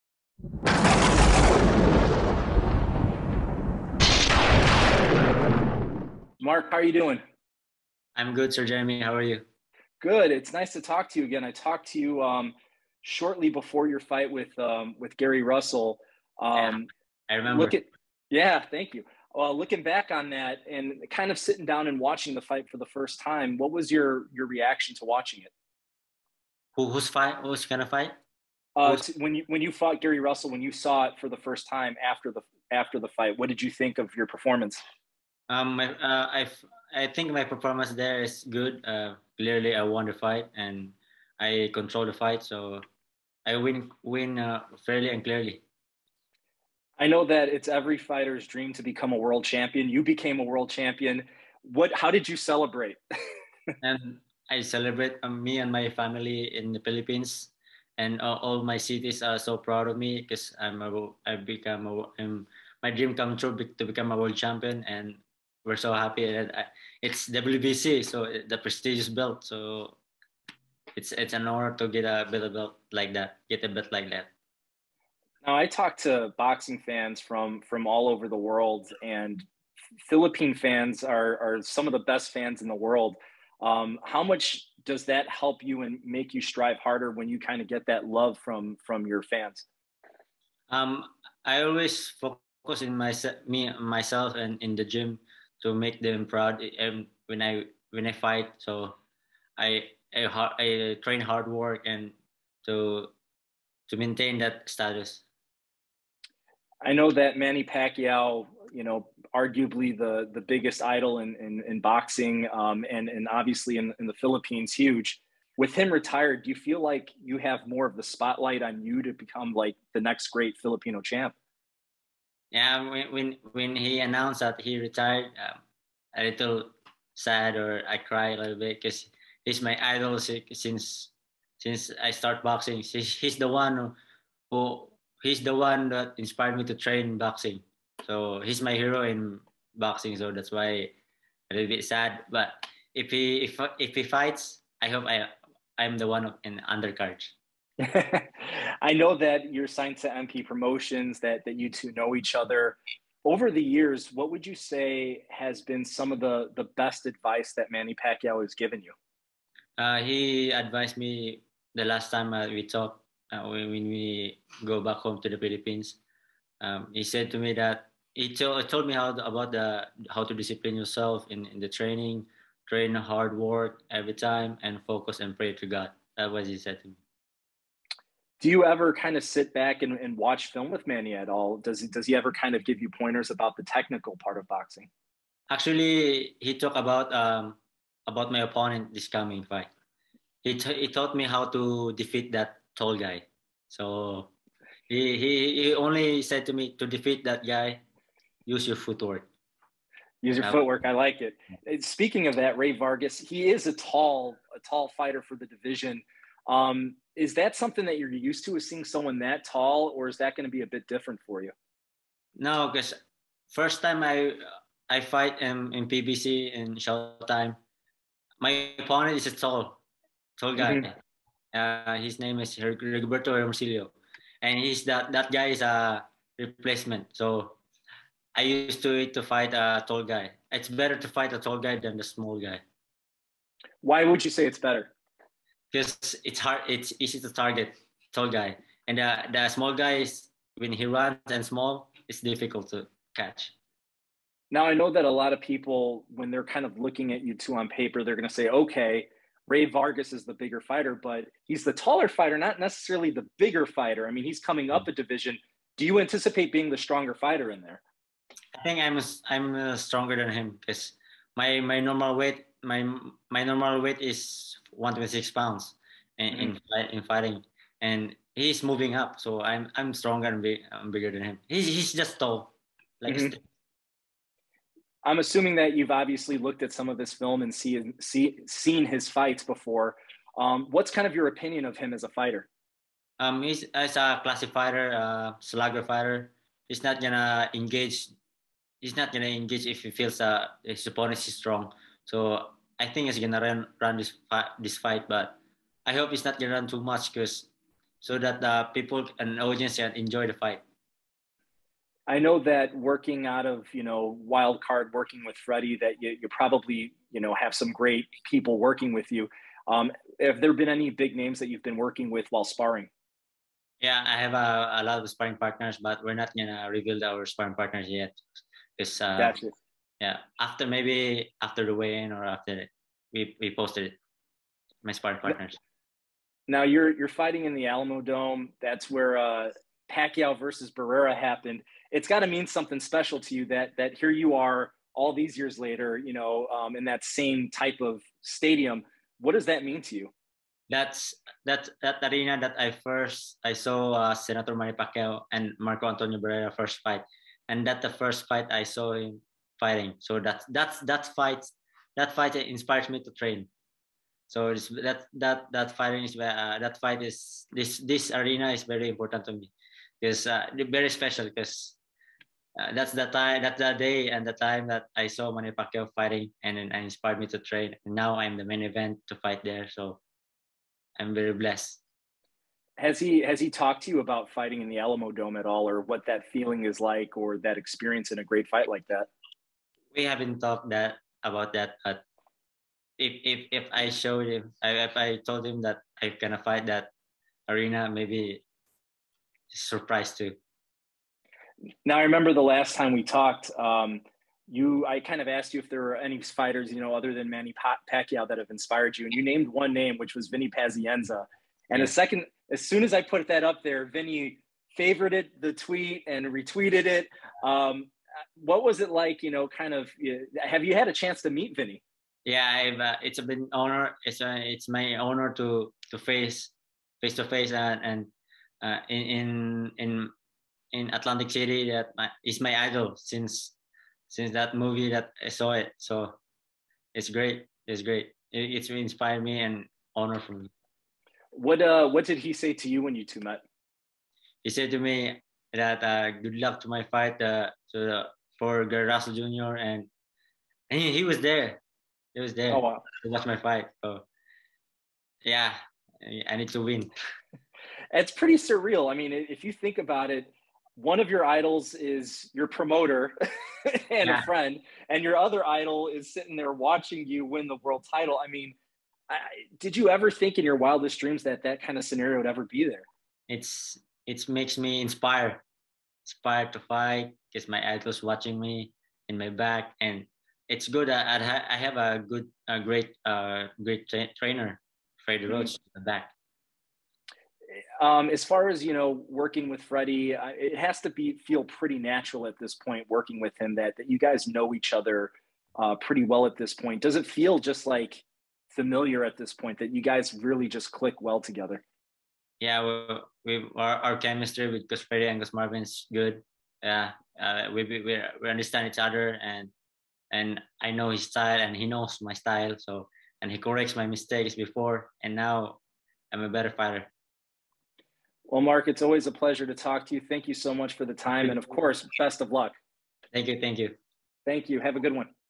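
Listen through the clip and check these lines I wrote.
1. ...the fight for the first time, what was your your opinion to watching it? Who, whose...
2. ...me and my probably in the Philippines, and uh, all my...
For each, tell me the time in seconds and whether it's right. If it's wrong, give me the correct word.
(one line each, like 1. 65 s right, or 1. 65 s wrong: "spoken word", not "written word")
1. 22 s wrong: "reaction", not "opinion"
2. 55 s wrong: "family", not "probably".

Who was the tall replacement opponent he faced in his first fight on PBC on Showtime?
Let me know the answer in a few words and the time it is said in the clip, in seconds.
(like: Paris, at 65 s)
Roberto Hermosillo, at 222 s.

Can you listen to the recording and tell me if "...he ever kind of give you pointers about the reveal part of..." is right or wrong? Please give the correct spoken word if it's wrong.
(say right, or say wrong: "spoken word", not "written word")
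wrong: "technical", not "reveal".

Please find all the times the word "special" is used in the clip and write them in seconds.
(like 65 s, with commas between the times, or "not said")
332 s, 360 s.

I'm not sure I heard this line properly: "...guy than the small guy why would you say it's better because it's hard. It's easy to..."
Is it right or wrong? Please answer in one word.
right.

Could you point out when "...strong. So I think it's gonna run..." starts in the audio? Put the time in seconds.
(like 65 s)
291 s.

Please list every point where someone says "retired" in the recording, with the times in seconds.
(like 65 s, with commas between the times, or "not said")
115 s, 124 s.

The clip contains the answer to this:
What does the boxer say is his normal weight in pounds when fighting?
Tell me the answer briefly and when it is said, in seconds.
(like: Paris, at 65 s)
126, at 264 s.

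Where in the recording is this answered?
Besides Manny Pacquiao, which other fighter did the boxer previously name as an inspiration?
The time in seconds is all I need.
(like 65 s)
400 s.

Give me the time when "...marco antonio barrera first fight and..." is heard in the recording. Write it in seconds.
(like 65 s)
345 s.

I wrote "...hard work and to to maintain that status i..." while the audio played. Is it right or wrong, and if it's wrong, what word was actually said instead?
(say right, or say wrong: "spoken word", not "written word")
right.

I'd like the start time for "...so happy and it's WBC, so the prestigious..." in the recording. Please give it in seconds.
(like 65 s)
65 s.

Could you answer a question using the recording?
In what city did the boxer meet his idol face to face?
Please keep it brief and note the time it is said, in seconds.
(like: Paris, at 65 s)
Atlantic City, at 420 s.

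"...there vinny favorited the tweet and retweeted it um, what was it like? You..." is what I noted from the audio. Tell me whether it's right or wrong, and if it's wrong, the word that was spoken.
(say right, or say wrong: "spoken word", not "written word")
right.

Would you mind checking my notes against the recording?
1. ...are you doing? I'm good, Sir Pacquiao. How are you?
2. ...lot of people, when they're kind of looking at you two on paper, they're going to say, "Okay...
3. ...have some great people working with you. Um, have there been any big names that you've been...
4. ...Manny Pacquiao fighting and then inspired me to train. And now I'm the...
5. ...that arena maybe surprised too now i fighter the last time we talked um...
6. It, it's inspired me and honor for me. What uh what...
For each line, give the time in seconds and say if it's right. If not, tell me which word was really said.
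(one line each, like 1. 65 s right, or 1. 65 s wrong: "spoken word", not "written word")
1. 6 s wrong: "Jeremy", not "Pacquiao"
2. 245 s right
3. 307 s right
4. 365 s right
5. 386 s wrong: "remember", not "fighter"
6. 428 s right.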